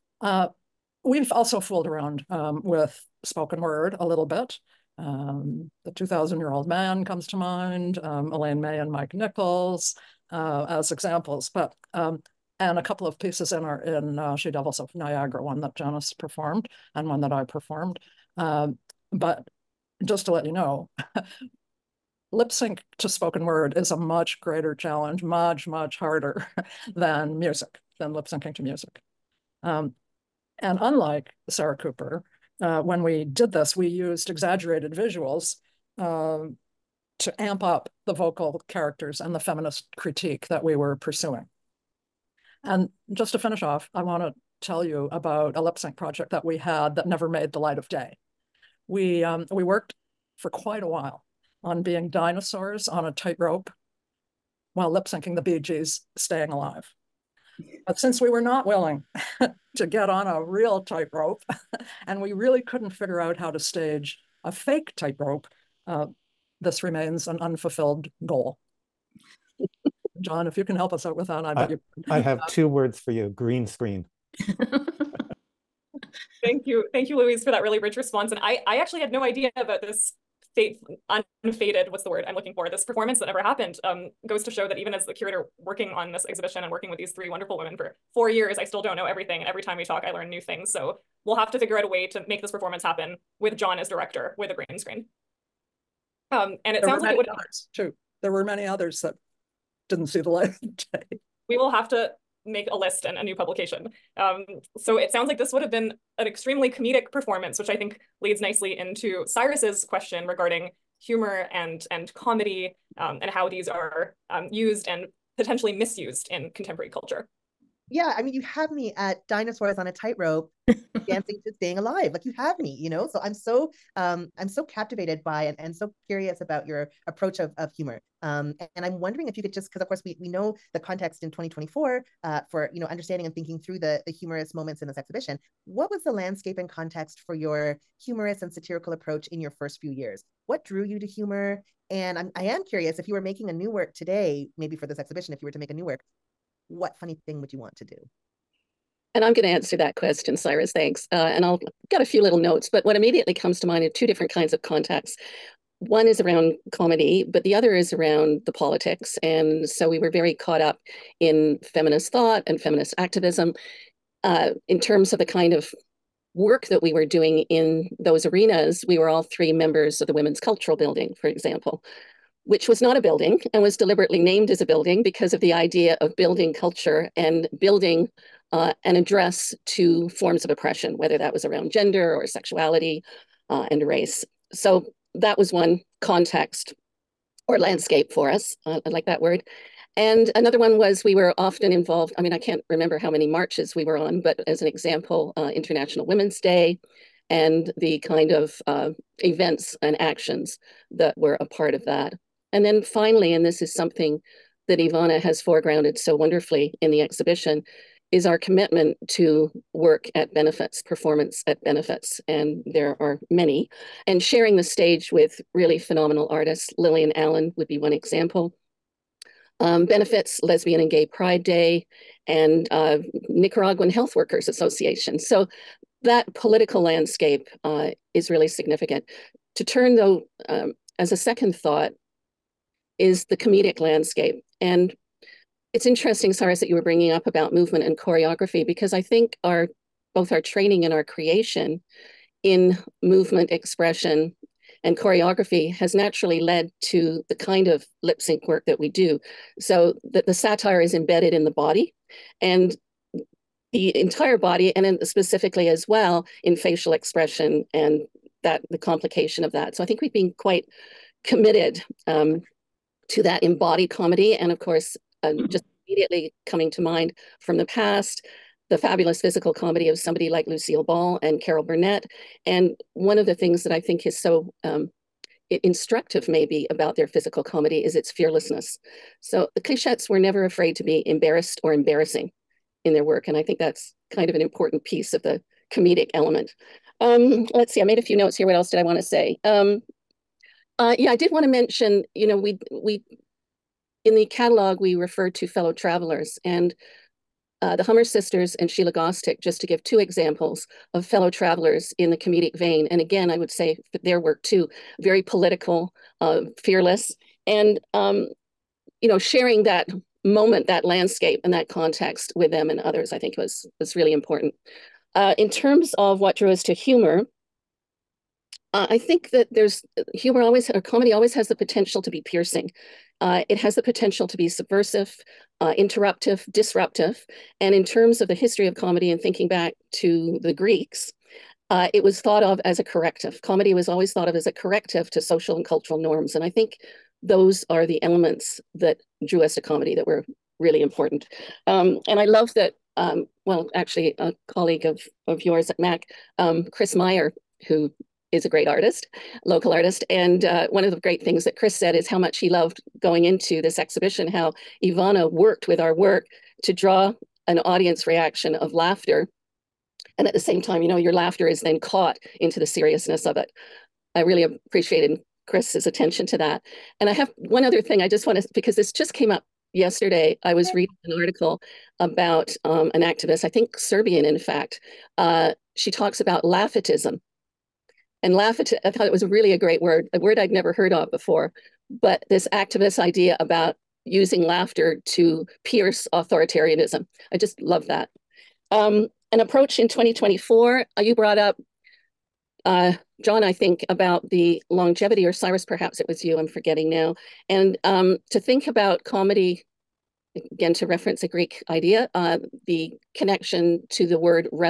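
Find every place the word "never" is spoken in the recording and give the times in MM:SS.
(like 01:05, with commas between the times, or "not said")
00:47, 01:23, 04:40, 06:20.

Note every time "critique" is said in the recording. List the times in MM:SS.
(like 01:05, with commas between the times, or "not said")
00:39.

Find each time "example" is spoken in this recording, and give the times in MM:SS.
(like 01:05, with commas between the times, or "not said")
00:10, 02:51, 03:14, 03:37, 04:59.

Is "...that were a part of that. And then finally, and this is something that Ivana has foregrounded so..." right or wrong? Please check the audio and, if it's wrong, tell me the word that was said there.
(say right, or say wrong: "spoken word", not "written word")
right.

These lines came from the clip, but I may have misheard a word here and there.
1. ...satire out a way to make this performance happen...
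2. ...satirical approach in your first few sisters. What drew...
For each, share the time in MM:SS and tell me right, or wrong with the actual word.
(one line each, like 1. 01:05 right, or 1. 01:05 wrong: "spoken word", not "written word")
1. 01:31 wrong: "figure", not "satire"
2. 02:18 wrong: "years", not "sisters".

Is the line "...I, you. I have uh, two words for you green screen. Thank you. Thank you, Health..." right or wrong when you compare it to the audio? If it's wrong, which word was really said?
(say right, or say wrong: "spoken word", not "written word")
wrong: "Louise", not "Health".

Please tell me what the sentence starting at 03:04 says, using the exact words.
So that was one context or landscape for us.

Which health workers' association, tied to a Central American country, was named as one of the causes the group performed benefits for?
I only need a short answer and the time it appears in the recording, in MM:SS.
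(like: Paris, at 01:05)
Nicaraguan Health Workers Association, at 03:43.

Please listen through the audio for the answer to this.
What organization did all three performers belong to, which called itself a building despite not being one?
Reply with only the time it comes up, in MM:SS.
02:50.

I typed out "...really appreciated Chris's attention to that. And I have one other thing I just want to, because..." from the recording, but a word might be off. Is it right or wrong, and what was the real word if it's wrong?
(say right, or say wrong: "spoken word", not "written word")
right.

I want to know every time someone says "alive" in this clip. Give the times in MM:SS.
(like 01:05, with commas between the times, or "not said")
00:56, 02:01.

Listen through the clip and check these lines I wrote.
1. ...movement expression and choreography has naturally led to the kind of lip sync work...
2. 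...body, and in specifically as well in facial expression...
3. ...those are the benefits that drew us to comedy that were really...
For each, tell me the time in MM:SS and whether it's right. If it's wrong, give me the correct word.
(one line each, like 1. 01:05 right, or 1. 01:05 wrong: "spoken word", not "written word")
1. 04:03 right
2. 04:14 right
3. 05:37 wrong: "elements", not "benefits".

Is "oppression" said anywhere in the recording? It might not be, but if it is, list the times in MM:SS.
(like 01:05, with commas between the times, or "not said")
03:00.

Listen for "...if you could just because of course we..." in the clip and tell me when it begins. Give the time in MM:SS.
02:09.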